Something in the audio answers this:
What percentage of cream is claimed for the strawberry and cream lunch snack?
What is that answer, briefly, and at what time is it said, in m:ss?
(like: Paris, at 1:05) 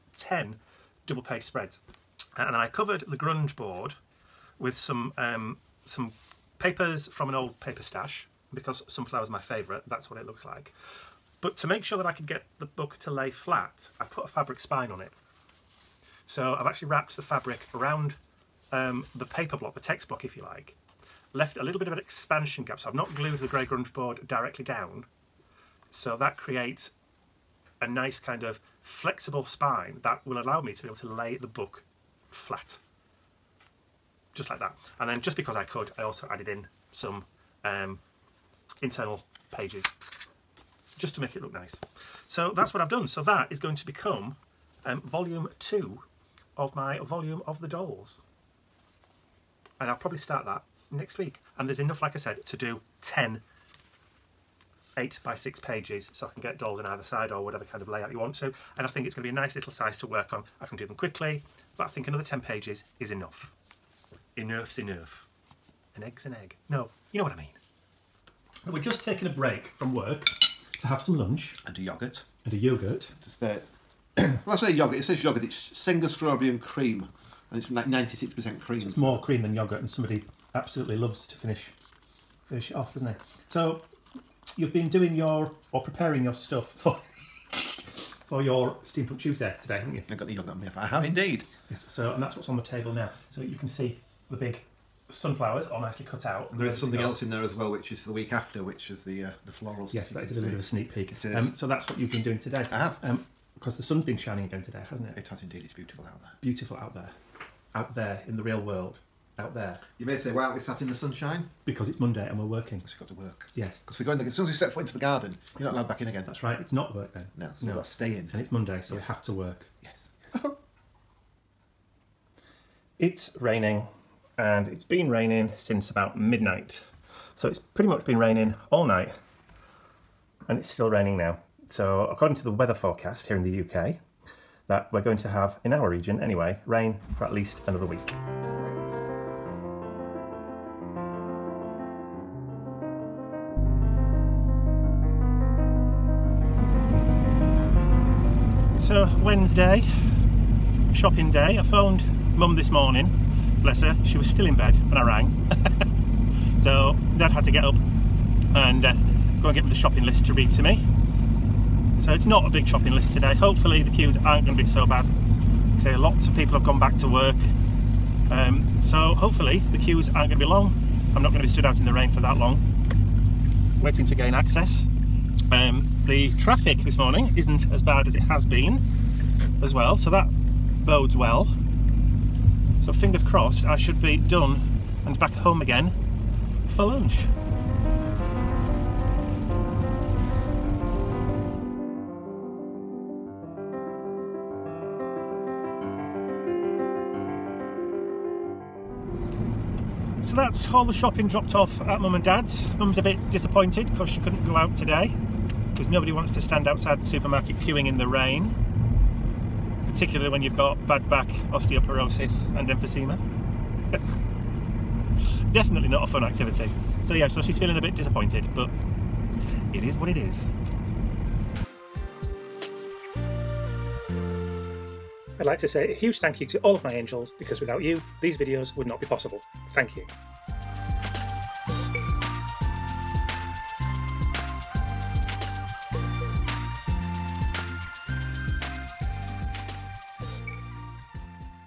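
96%, at 1:17.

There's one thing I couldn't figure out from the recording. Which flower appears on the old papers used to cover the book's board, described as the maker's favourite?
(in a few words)
Sunflower.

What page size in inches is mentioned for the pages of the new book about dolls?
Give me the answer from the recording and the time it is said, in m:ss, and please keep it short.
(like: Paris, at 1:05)
8 by 6, at 0:54.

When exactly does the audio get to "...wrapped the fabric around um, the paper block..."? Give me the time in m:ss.
0:16.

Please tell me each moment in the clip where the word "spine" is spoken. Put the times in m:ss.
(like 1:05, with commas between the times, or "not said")
0:14, 0:29.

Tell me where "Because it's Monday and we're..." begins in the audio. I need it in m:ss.
1:51.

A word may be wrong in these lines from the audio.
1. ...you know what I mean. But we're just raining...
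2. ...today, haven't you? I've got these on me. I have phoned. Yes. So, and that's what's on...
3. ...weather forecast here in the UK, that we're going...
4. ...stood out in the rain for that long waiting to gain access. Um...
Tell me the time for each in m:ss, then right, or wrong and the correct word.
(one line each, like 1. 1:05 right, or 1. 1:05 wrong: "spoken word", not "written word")
1. 1:07 wrong: "taking", not "raining"
2. 1:29 wrong: "indeed", not "phoned"
3. 2:12 right
4. 2:51 right.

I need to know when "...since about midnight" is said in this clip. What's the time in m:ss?
2:05.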